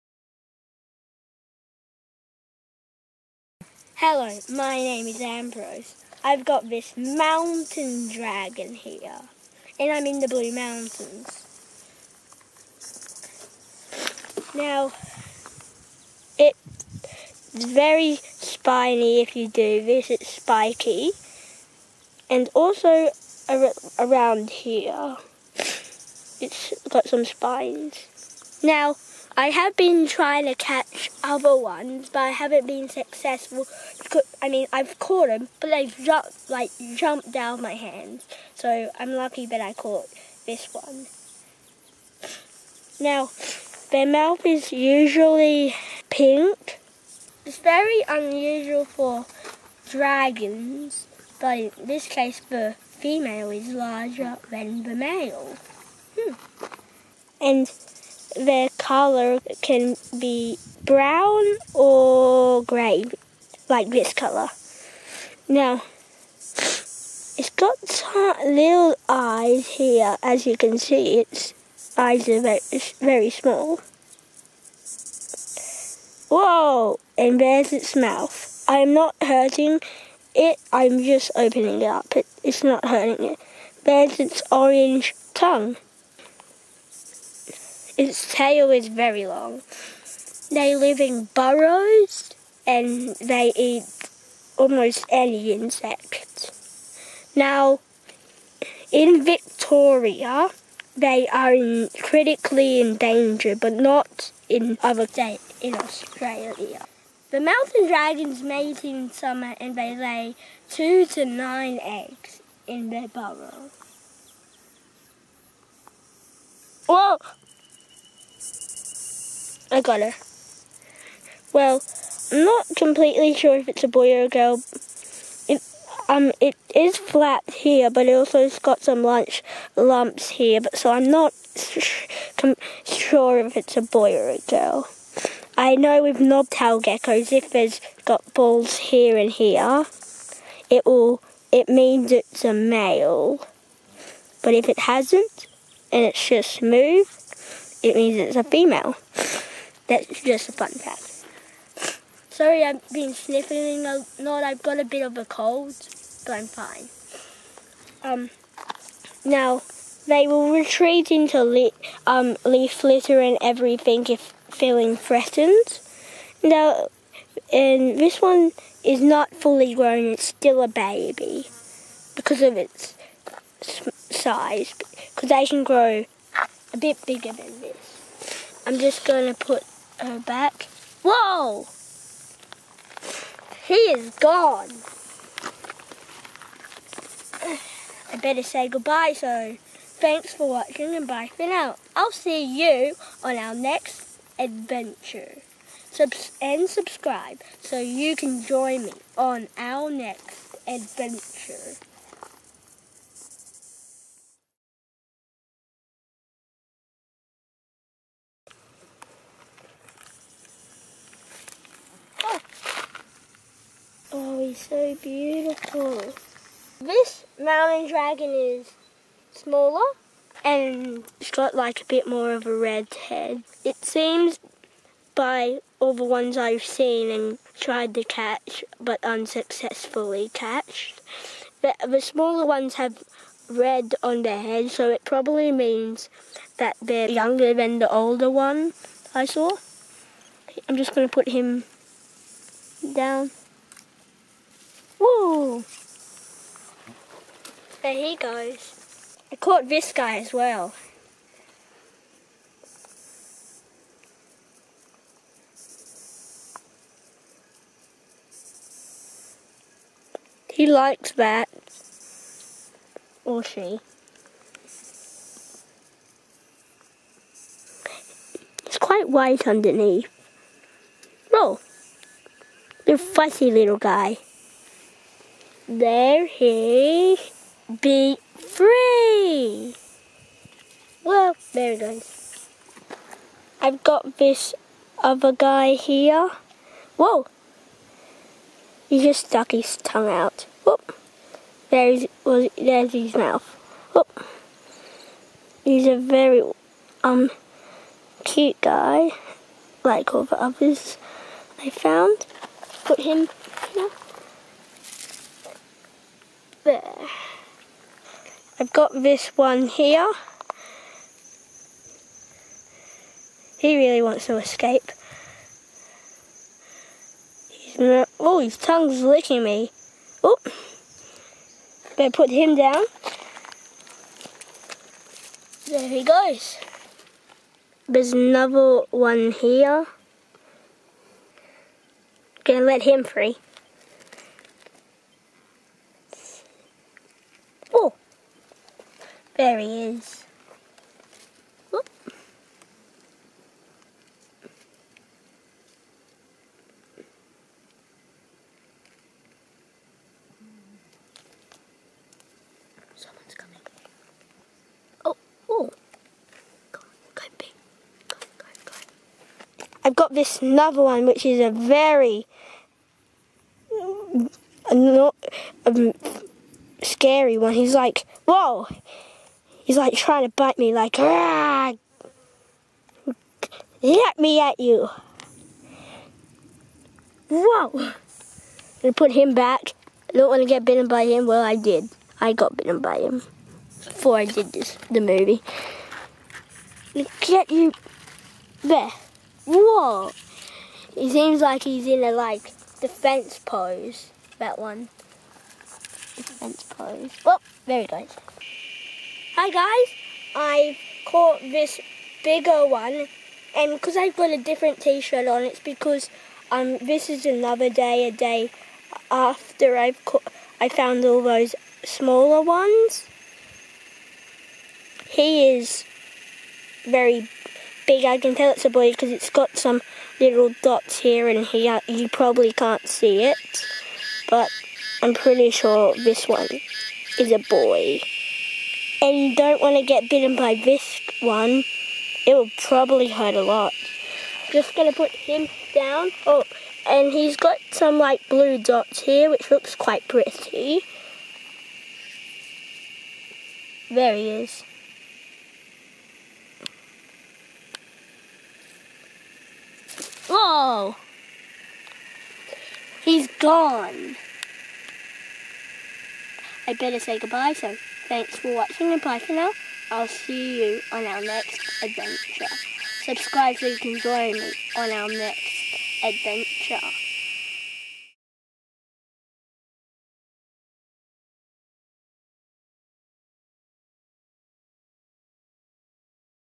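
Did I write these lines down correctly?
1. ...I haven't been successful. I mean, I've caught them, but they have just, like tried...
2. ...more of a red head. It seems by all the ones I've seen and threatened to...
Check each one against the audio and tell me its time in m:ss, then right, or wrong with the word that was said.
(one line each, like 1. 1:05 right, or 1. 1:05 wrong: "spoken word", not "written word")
1. 0:32 wrong: "jumped", not "tried"
2. 3:42 wrong: "tried", not "threatened".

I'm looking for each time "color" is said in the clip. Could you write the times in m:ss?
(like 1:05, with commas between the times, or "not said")
0:58, 1:04.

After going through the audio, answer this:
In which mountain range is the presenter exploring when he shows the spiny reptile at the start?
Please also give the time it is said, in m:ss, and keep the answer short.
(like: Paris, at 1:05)
Blue Mountains, at 0:10.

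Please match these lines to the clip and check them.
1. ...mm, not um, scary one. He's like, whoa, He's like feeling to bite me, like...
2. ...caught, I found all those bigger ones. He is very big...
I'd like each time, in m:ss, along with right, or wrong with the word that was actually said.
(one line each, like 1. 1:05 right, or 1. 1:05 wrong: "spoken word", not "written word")
1. 6:03 wrong: "trying", not "feeling"
2. 6:50 wrong: "smaller", not "bigger".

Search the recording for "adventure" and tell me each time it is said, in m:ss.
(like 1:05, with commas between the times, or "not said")
3:14, 3:20, 7:41, 7:46.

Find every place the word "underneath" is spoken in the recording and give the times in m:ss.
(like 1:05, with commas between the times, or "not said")
4:29.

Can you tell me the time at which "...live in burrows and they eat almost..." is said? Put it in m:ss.
1:30.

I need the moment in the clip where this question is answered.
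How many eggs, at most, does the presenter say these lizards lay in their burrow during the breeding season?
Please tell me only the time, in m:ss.
1:51.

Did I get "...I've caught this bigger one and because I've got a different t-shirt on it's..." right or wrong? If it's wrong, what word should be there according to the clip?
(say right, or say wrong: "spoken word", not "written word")
right.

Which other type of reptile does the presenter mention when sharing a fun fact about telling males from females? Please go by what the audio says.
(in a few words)
Knobtail geckos.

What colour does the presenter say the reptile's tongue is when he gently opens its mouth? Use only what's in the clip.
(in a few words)
Orange.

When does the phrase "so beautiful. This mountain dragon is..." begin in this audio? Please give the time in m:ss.
3:34.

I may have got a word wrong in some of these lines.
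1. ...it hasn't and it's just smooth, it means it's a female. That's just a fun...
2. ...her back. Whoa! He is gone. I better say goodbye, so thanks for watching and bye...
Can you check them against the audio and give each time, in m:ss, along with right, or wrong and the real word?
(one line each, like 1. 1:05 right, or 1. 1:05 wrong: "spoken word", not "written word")
1. 2:24 right
2. 3:00 right.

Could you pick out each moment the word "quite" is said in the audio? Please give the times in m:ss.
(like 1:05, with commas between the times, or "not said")
4:28, 7:19.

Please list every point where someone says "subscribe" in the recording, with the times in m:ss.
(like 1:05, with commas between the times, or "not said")
3:16, 7:43.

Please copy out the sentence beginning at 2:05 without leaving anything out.
It, um, it is flat here, but it also has got some lunch lumps here.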